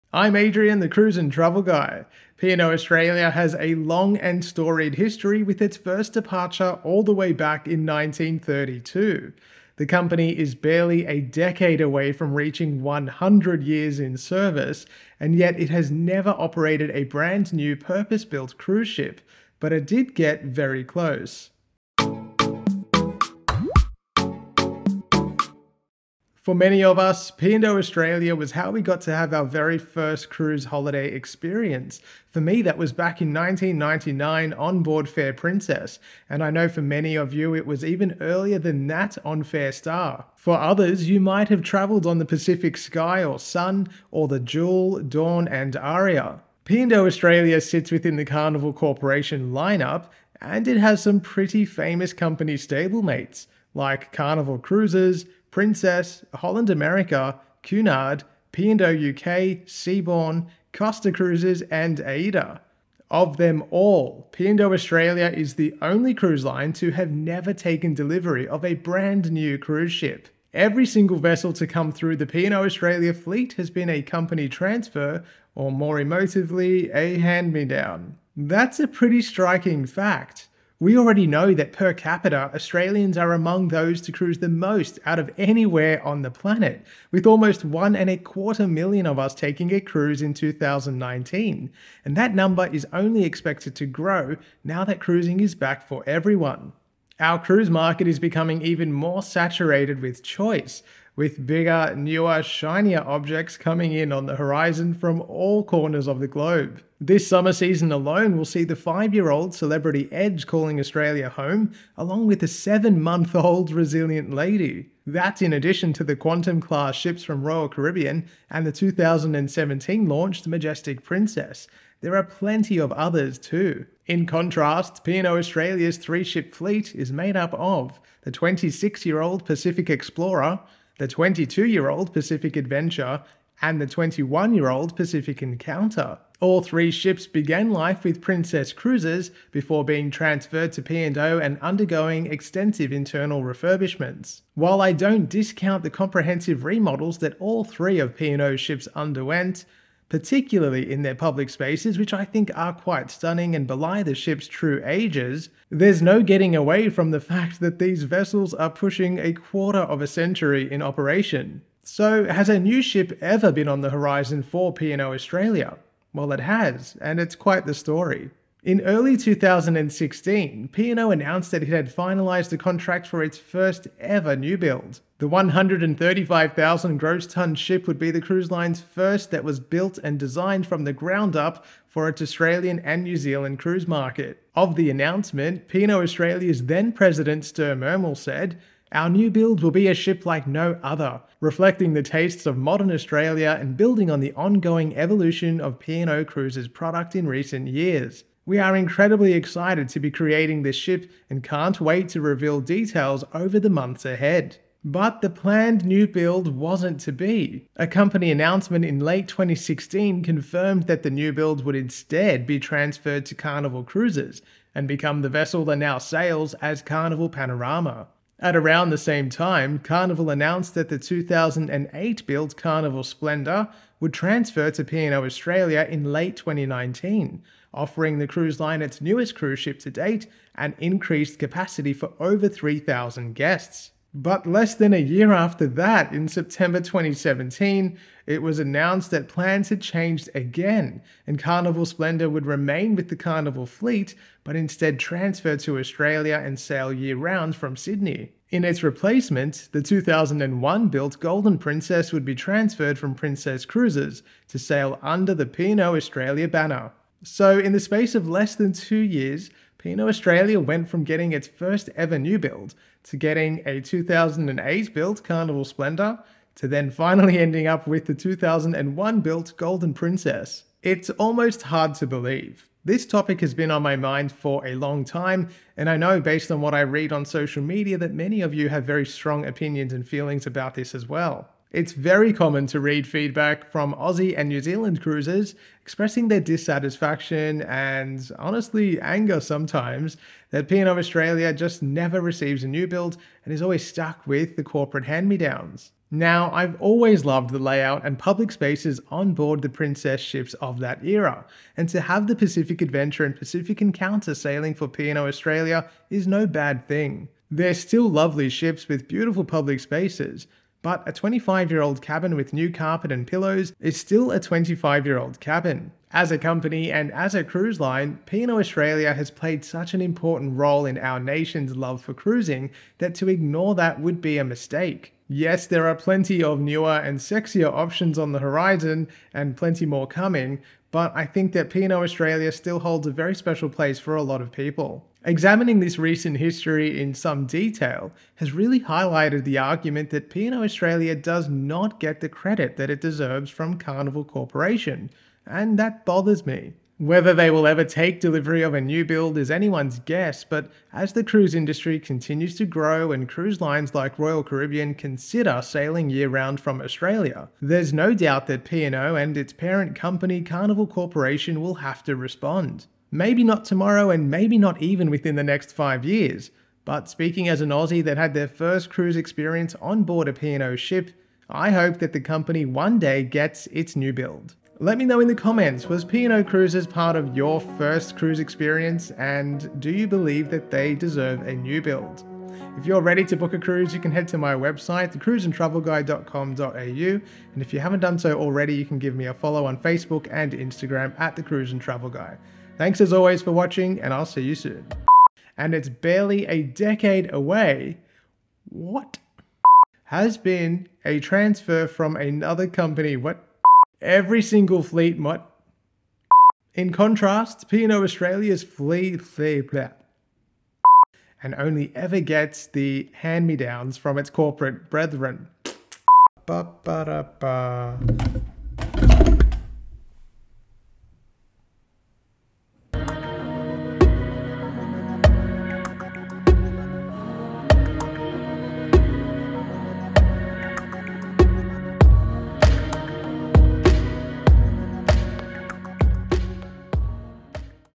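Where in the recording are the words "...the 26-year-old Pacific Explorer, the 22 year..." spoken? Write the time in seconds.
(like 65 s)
128 s.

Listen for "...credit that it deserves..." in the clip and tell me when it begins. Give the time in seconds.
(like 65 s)
342 s.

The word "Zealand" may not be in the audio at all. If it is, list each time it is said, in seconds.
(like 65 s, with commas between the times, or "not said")
183 s, 284 s.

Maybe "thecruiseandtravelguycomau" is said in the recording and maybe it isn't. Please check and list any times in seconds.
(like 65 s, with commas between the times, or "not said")
385 s.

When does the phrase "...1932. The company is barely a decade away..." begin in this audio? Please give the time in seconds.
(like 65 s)
7 s.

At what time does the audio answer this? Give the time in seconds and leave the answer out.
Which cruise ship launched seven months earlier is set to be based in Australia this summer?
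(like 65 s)
113 s.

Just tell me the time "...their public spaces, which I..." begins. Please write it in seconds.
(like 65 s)
151 s.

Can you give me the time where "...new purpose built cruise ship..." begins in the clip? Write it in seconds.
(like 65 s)
17 s.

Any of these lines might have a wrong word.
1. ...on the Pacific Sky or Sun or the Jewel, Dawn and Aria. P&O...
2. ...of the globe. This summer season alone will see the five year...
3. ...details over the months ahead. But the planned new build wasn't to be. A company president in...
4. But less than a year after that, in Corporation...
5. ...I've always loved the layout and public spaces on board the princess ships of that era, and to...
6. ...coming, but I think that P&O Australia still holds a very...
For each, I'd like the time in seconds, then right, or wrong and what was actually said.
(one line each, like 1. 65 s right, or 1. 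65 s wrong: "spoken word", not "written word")
1. 42 s right
2. 106 s right
3. 202 s wrong: "announcement", not "president"
4. 234 s wrong: "September", not "Corporation"
5. 296 s right
6. 330 s right.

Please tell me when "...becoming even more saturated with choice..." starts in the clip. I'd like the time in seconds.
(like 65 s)
98 s.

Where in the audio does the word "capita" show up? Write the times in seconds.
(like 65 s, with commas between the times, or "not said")
81 s.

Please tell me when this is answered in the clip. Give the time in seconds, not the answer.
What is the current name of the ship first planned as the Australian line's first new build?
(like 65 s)
216 s.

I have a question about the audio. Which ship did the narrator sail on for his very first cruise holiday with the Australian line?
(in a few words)
Fair Princess.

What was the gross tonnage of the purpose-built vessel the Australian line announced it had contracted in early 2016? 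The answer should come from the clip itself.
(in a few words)
135,000.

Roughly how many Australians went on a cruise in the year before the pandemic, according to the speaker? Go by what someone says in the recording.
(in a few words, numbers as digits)
1.25 million.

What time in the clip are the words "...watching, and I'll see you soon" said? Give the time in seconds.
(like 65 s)
393 s.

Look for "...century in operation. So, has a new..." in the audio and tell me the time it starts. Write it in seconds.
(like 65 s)
160 s.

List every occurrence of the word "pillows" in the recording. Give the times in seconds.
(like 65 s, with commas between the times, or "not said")
313 s.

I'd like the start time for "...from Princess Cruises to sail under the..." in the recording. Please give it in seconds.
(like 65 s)
252 s.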